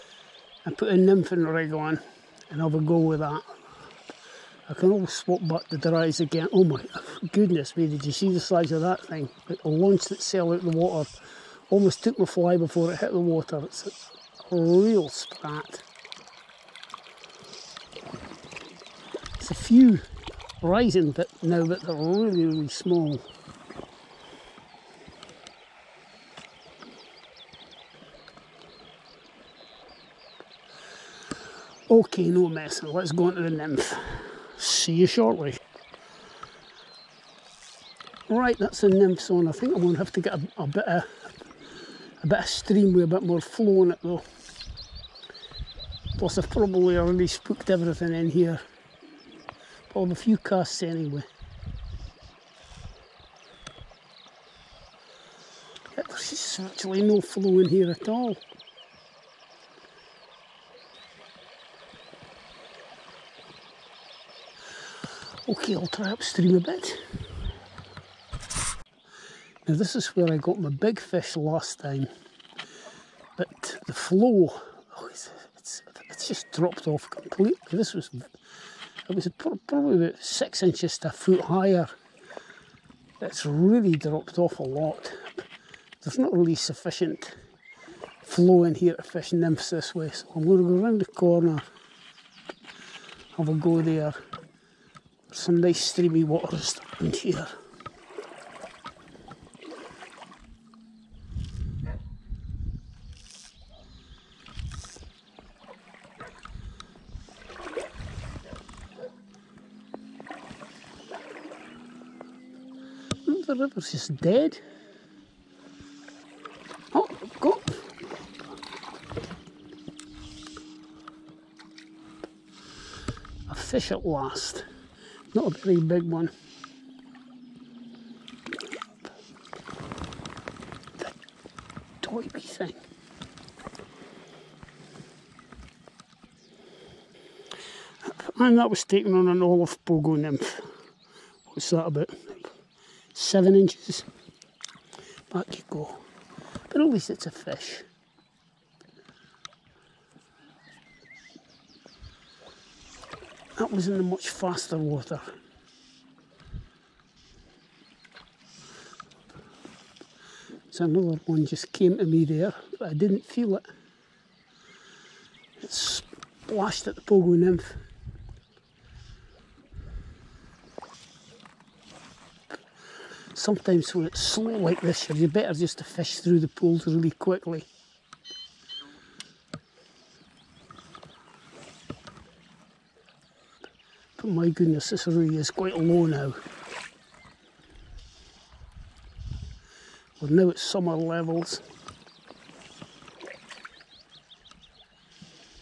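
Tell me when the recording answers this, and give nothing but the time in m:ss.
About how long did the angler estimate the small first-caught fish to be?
2:23.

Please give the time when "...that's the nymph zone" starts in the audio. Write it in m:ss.
0:38.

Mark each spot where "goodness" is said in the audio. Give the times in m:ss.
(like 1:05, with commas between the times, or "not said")
0:07, 3:04.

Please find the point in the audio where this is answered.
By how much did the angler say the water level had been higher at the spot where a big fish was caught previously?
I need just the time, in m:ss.
1:20.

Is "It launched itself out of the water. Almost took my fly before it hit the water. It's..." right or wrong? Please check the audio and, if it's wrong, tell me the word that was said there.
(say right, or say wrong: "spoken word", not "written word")
right.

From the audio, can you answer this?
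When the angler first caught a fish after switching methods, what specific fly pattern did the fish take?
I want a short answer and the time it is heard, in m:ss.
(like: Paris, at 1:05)
Olive pogo nymph, at 2:19.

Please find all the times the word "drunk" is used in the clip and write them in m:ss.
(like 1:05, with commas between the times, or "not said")
not said.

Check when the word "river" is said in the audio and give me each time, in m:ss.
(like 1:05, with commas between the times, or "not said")
1:53.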